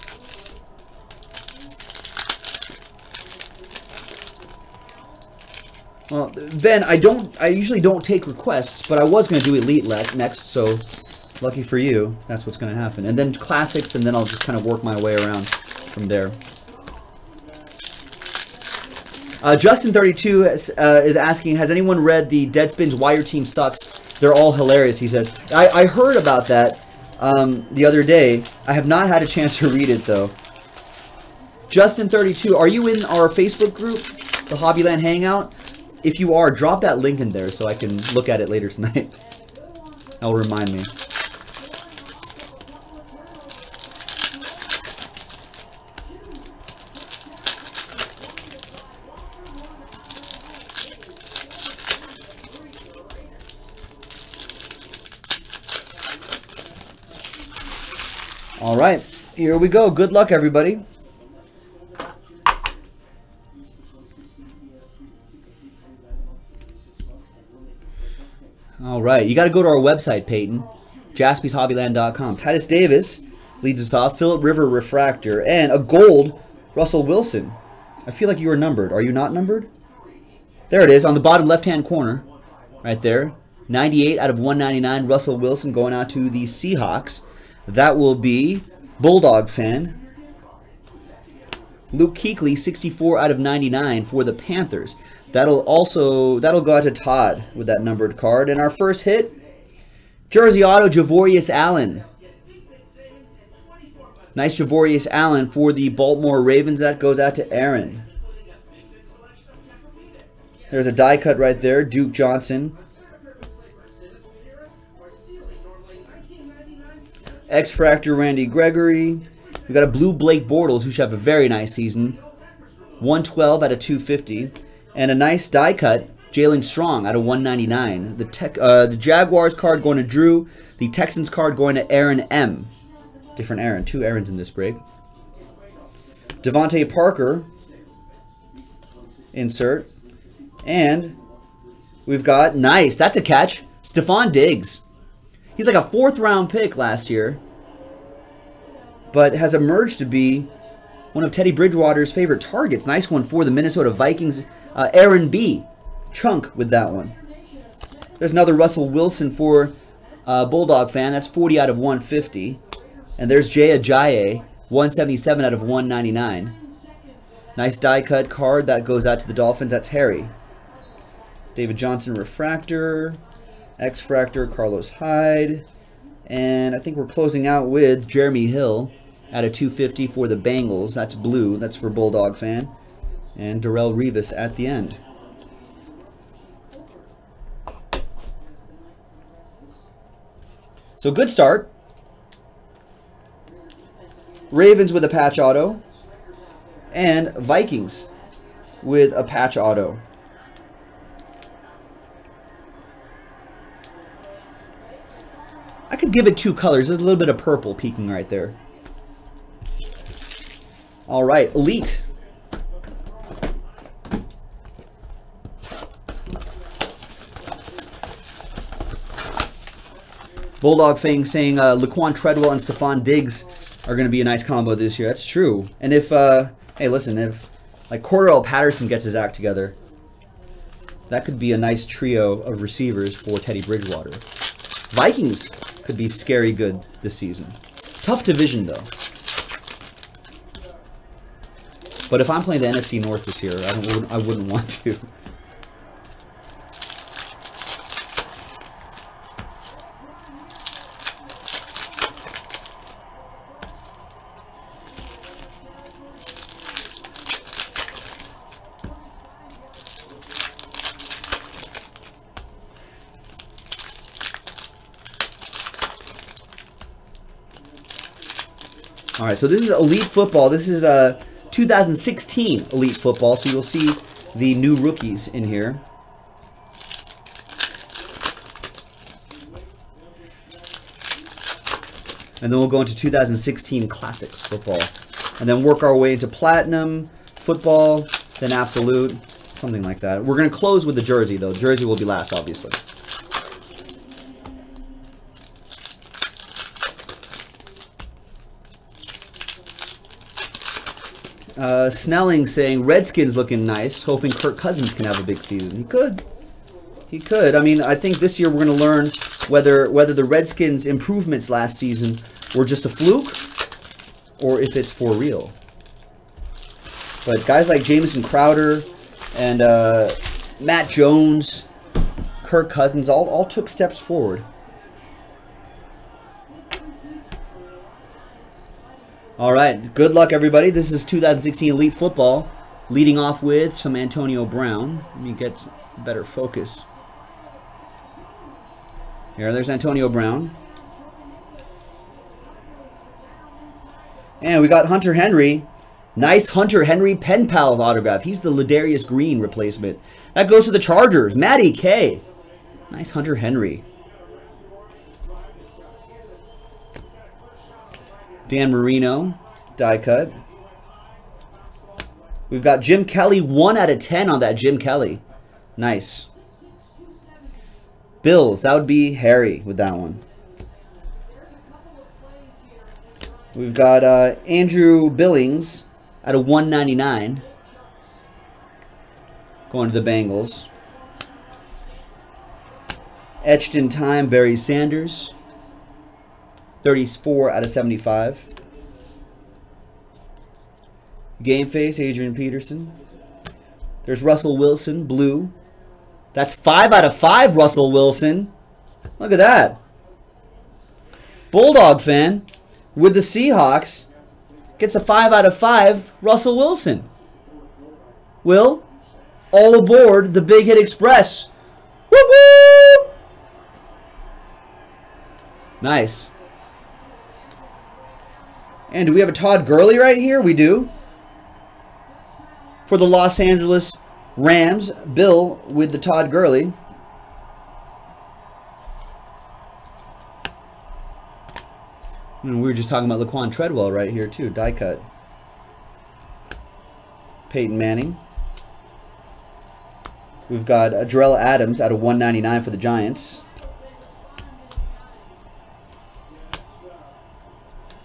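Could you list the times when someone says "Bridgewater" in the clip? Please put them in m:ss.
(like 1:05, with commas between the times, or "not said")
2:31, 3:53.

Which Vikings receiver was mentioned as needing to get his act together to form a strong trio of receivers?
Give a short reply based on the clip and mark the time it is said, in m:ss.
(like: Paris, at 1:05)
Cordarrelle Patterson, at 3:48.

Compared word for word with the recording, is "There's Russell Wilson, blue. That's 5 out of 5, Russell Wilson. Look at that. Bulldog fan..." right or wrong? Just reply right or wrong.
right.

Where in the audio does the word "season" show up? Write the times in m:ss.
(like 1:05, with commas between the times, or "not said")
2:01, 3:57, 5:05, 5:11.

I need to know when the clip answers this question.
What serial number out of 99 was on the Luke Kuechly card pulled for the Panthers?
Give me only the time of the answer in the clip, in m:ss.
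1:32.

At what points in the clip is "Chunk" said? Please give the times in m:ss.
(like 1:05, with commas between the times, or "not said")
2:36.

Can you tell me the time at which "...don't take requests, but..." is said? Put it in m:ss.
0:07.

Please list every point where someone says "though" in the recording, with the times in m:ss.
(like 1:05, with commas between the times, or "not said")
0:30, 3:58, 4:51.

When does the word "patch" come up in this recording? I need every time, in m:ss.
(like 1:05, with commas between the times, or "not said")
3:15, 3:19.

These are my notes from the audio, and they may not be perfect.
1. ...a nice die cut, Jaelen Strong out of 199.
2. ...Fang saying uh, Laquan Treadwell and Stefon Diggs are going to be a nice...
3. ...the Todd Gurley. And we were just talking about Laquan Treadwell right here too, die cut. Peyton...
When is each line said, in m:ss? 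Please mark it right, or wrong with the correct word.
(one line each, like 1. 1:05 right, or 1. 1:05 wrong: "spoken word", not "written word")
1. 2:05 right
2. 3:40 right
3. 7:05 right.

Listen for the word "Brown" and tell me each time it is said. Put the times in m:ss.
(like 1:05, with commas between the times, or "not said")
5:34, 5:40.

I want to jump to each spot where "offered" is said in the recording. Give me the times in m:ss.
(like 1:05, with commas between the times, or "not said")
not said.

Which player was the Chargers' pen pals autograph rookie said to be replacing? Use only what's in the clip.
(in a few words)
Ladarius Green.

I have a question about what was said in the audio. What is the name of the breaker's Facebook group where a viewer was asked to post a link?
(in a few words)
Hobbyland Hangout.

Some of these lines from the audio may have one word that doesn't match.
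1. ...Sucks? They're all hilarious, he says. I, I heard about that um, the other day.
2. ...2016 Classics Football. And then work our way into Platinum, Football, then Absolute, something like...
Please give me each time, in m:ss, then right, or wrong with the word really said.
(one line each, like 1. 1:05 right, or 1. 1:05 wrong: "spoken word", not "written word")
1. 0:23 right
2. 4:42 right.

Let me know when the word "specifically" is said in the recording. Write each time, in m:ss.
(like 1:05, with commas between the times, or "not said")
not said.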